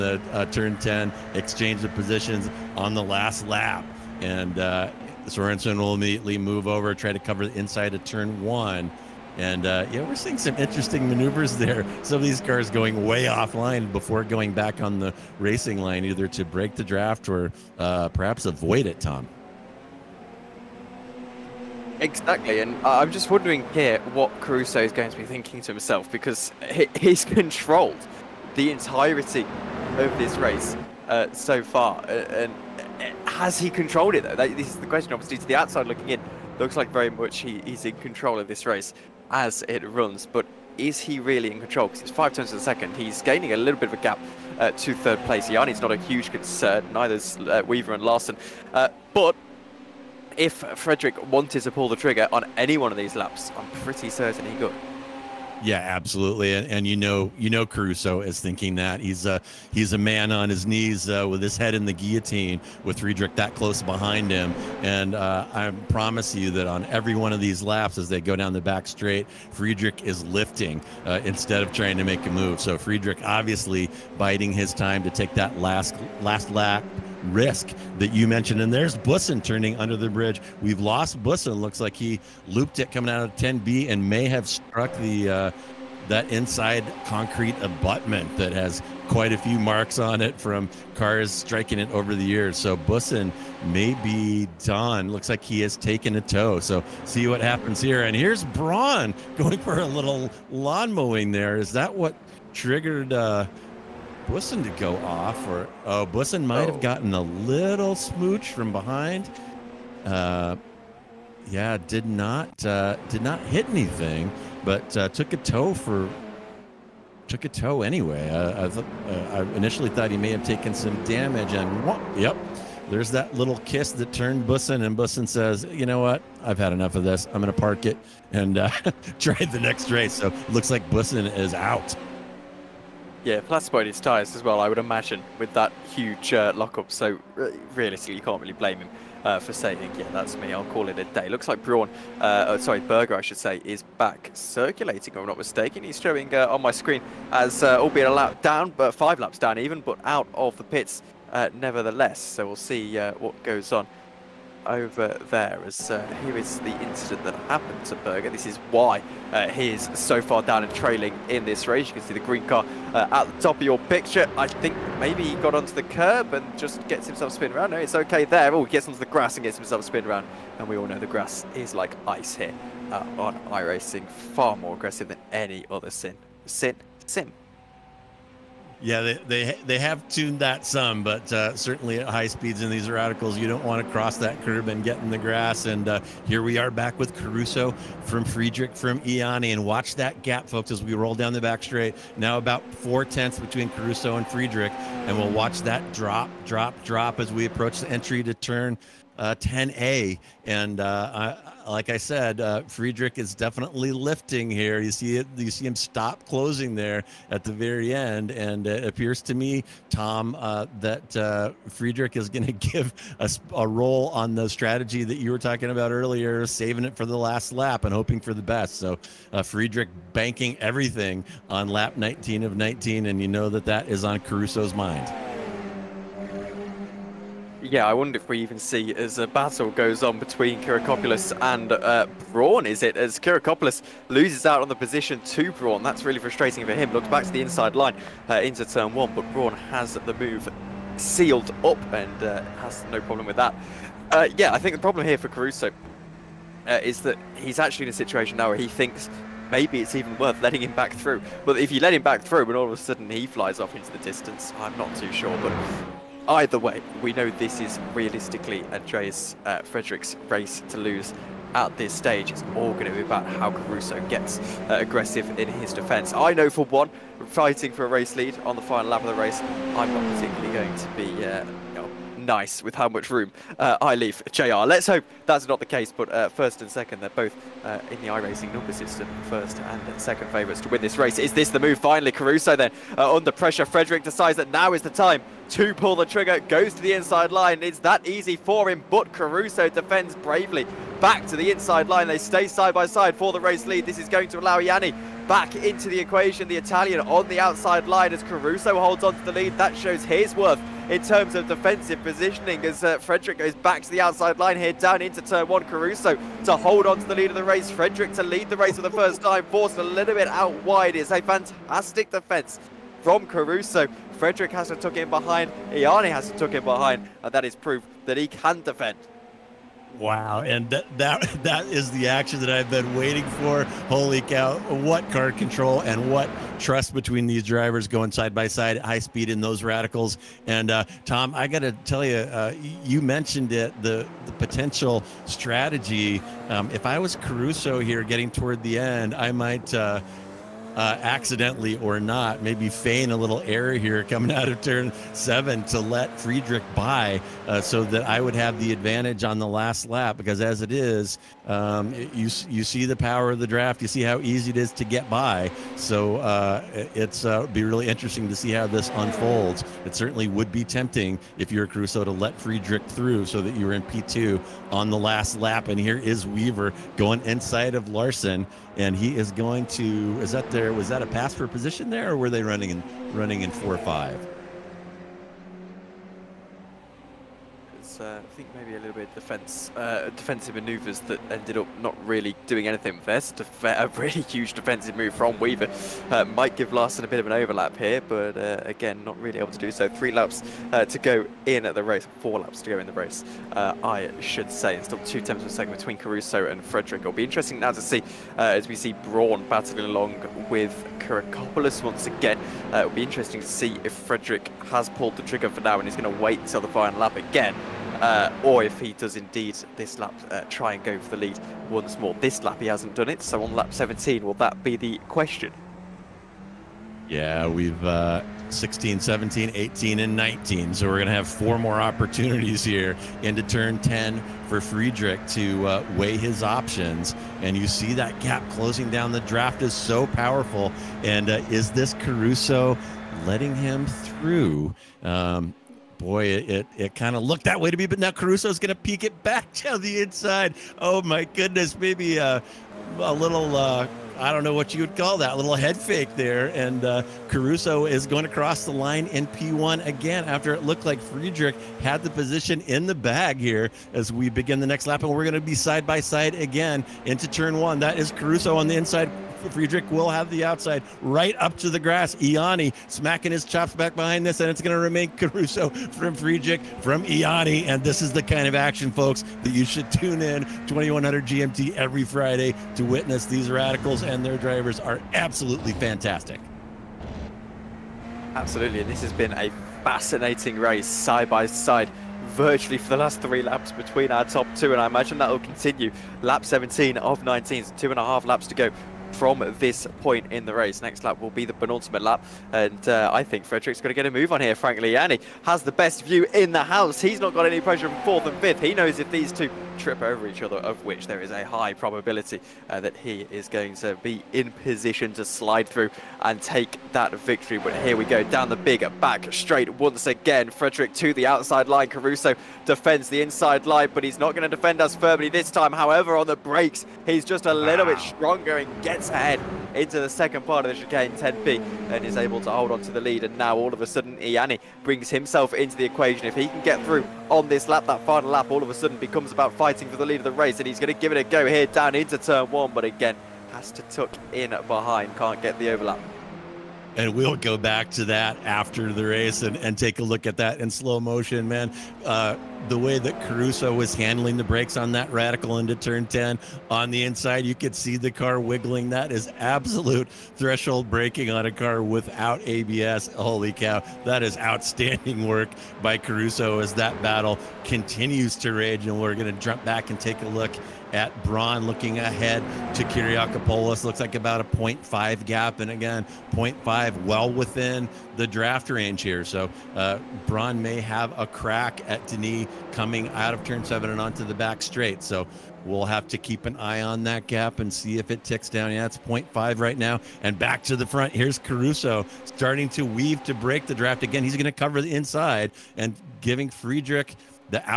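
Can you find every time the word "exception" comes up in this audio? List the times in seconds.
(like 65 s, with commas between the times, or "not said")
not said.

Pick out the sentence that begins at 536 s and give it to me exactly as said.
And we'll go back to that after the race and, and take a look at that in slow motion, man.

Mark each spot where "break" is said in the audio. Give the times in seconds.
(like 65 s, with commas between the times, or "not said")
16 s, 583 s.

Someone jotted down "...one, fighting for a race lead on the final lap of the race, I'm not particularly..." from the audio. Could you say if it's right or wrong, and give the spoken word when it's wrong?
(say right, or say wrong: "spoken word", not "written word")
right.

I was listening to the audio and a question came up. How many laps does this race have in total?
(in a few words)
19.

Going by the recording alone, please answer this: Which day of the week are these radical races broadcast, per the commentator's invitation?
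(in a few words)
Friday.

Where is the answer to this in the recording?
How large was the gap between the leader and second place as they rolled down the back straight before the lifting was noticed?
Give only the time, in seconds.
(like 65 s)
192 s.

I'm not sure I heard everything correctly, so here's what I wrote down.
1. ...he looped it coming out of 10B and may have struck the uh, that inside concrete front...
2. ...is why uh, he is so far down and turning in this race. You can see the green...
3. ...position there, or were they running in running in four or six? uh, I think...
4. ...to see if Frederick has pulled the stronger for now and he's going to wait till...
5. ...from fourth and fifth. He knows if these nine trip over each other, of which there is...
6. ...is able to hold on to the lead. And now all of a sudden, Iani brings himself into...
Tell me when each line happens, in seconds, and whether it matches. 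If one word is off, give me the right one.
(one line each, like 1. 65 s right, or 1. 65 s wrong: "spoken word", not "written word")
1. 81 s wrong: "abutment", not "front"
2. 158 s wrong: "trailing", not "turning"
3. 371 s wrong: "five", not "six"
4. 403 s wrong: "trigger", not "stronger"
5. 497 s wrong: "two", not "nine"
6. 522 s right.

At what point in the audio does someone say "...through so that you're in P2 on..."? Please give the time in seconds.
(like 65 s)
362 s.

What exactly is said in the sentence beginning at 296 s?
The Italian on the outside line as Caruso holds on to the lead.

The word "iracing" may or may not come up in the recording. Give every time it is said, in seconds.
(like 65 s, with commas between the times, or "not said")
173 s, 278 s.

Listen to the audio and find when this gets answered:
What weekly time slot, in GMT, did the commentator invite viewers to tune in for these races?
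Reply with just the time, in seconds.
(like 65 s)
470 s.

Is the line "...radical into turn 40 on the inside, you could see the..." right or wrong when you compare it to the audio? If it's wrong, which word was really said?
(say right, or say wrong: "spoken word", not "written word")
wrong: "10", not "40".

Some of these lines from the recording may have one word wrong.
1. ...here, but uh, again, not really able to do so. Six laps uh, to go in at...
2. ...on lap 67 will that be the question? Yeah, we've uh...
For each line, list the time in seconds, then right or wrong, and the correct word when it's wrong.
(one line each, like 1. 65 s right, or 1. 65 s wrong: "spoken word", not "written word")
1. 387 s wrong: "Three", not "Six"
2. 413 s wrong: "17", not "67".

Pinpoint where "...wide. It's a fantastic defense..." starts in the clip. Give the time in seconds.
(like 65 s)
310 s.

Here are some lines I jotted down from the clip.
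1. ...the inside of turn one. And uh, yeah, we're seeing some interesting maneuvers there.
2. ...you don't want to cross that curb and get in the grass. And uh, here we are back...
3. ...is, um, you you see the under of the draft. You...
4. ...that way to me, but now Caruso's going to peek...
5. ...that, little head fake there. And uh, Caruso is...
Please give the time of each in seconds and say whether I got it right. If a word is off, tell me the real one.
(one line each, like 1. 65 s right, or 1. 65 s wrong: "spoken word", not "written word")
1. 7 s right
2. 183 s right
3. 350 s wrong: "power", not "under"
4. 437 s right
5. 445 s right.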